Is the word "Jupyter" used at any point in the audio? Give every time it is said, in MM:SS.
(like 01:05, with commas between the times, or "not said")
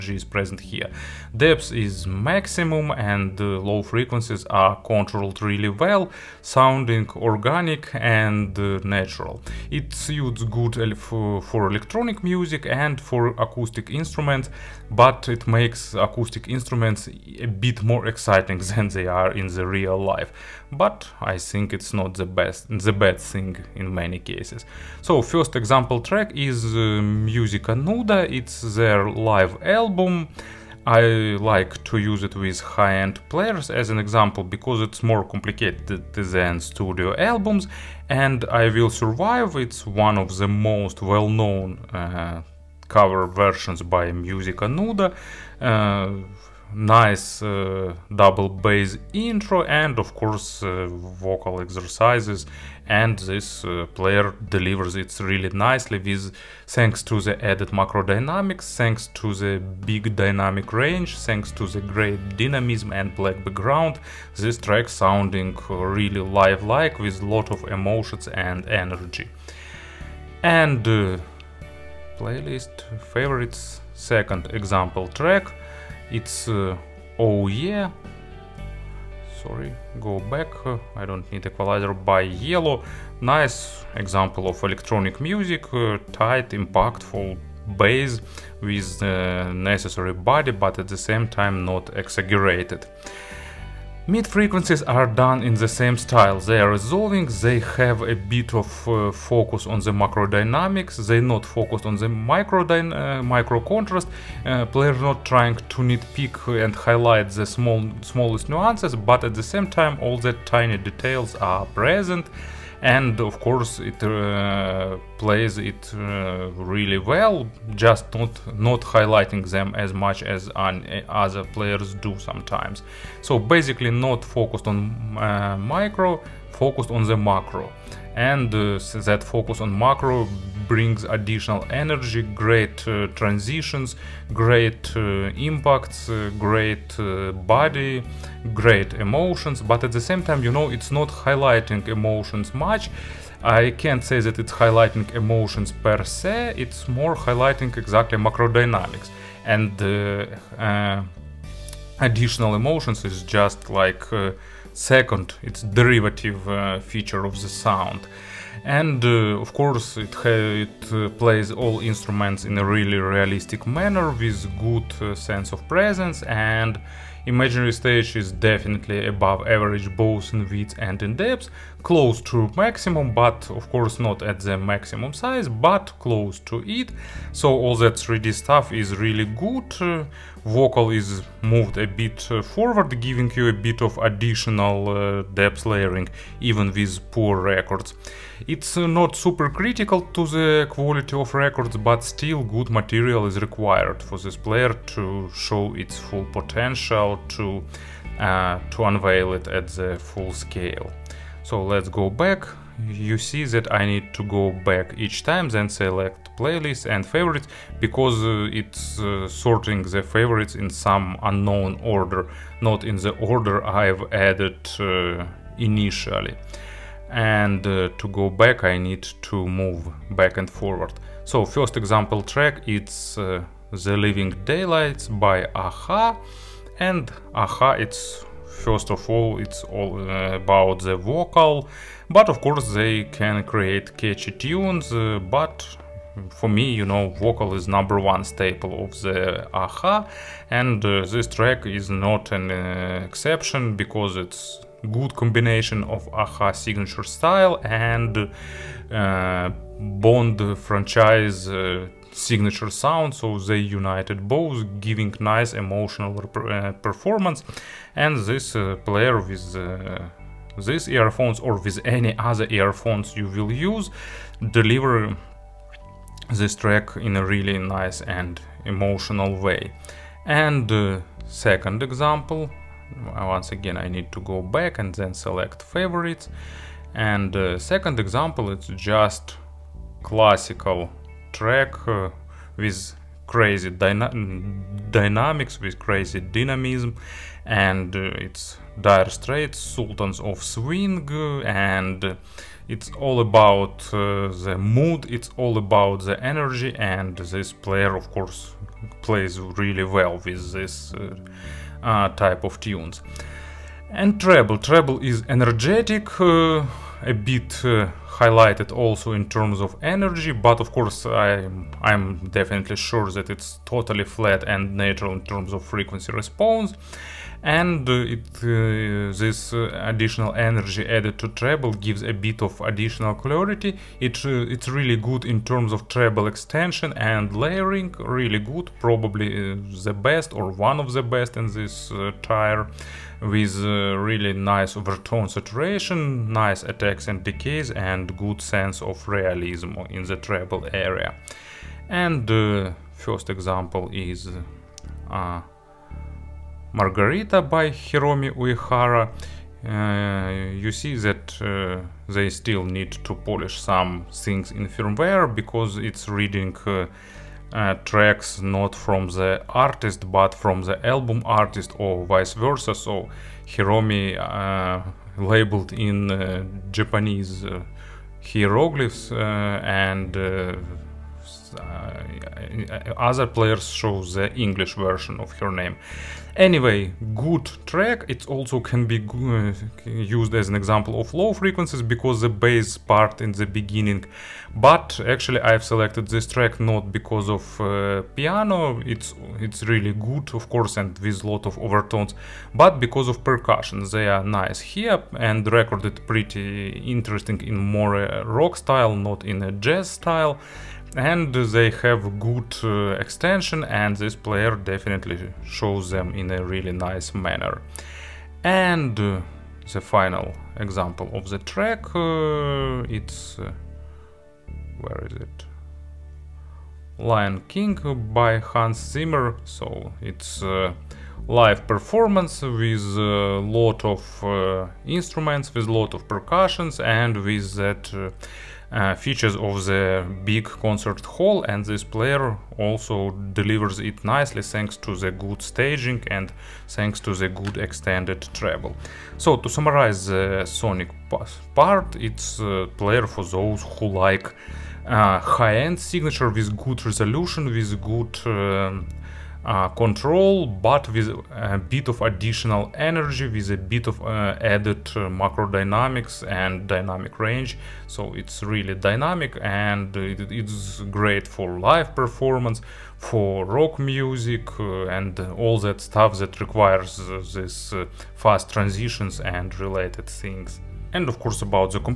not said.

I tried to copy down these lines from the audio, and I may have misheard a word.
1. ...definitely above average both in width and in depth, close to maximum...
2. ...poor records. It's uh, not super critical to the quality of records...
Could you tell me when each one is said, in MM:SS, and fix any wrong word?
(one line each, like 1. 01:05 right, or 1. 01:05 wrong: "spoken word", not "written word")
1. 02:48 right
2. 03:07 right.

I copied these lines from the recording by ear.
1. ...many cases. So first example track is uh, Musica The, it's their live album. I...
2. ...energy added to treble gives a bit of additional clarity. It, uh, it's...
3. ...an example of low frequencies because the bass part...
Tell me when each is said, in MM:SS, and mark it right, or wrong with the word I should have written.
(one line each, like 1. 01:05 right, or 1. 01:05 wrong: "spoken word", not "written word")
1. 00:23 wrong: "Nuda", not "The"
2. 05:20 right
3. 06:20 right.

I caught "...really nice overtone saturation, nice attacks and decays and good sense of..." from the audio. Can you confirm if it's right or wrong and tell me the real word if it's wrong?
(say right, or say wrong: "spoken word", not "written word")
right.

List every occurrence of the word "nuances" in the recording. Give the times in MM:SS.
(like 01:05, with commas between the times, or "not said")
01:48.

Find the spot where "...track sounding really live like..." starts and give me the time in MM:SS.
01:04.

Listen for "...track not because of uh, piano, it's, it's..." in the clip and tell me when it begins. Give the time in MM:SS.
06:26.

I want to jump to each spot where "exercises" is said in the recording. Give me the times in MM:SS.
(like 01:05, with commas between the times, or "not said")
00:51.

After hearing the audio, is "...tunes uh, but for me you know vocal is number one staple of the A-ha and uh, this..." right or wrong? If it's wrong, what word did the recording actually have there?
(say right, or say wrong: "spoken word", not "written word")
right.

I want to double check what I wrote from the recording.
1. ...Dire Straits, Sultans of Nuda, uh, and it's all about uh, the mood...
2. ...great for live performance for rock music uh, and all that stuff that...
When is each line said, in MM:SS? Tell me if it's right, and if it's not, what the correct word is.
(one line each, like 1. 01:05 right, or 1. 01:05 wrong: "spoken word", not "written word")
1. 04:48 wrong: "Swing", not "Nuda"
2. 07:40 right.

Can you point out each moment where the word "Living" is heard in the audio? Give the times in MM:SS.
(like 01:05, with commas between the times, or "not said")
03:43.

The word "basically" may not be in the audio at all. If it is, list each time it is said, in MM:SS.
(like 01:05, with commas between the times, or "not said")
02:03.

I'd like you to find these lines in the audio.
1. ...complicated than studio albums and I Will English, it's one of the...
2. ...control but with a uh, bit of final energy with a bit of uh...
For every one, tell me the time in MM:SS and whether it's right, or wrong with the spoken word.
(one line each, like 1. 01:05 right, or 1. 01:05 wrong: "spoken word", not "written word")
1. 00:35 wrong: "Survive", not "English"
2. 07:29 wrong: "additional", not "final".